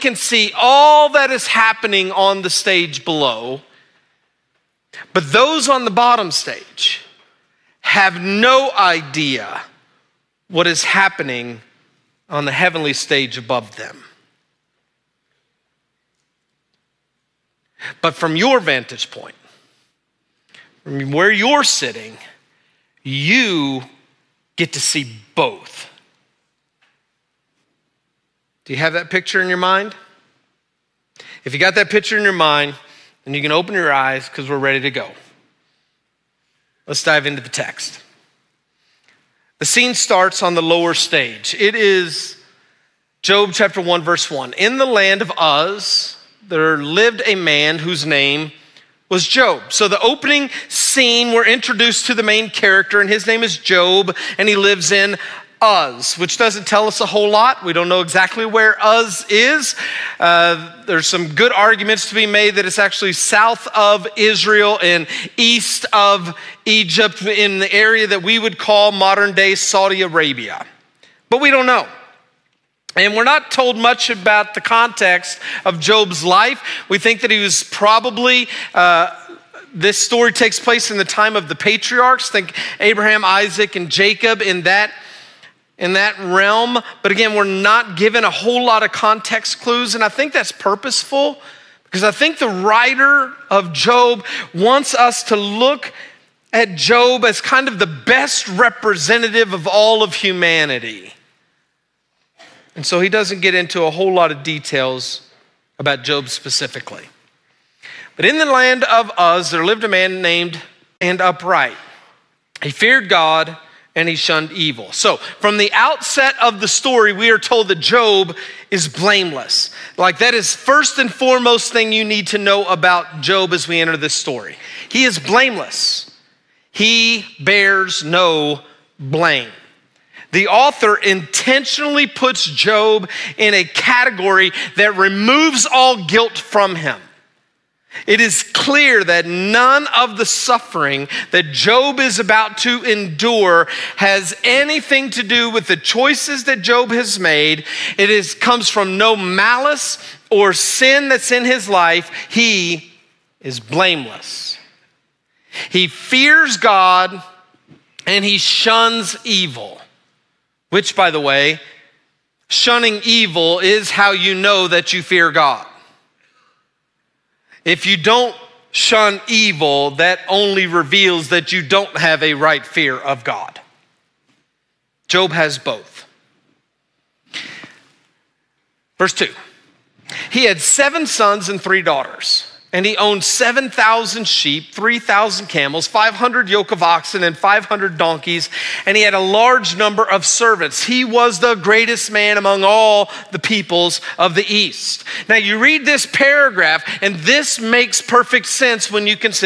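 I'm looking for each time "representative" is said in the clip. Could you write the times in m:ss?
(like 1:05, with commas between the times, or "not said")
1:38.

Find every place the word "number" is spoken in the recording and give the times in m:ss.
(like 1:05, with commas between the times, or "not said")
3:09.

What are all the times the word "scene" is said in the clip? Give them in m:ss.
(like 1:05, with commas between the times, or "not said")
0:39, 0:50.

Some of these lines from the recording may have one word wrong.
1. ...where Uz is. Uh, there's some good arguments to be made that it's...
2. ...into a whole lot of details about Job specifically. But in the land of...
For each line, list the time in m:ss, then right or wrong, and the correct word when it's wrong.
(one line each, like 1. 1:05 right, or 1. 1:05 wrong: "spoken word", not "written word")
1. 0:58 right
2. 1:43 right.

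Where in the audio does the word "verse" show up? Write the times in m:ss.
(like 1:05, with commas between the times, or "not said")
0:44, 2:58.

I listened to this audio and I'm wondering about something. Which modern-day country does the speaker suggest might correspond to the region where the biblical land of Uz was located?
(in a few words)
Saudi Arabia.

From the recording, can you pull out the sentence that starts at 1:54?
So, from the outset of the story, we are told that Job is blameless.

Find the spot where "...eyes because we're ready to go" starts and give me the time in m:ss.
0:33.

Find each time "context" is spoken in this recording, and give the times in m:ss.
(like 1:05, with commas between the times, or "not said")
1:14, 1:28.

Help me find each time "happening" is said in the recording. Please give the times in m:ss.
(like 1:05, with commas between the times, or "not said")
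0:01, 0:10.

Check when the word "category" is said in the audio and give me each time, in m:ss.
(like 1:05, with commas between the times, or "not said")
2:13.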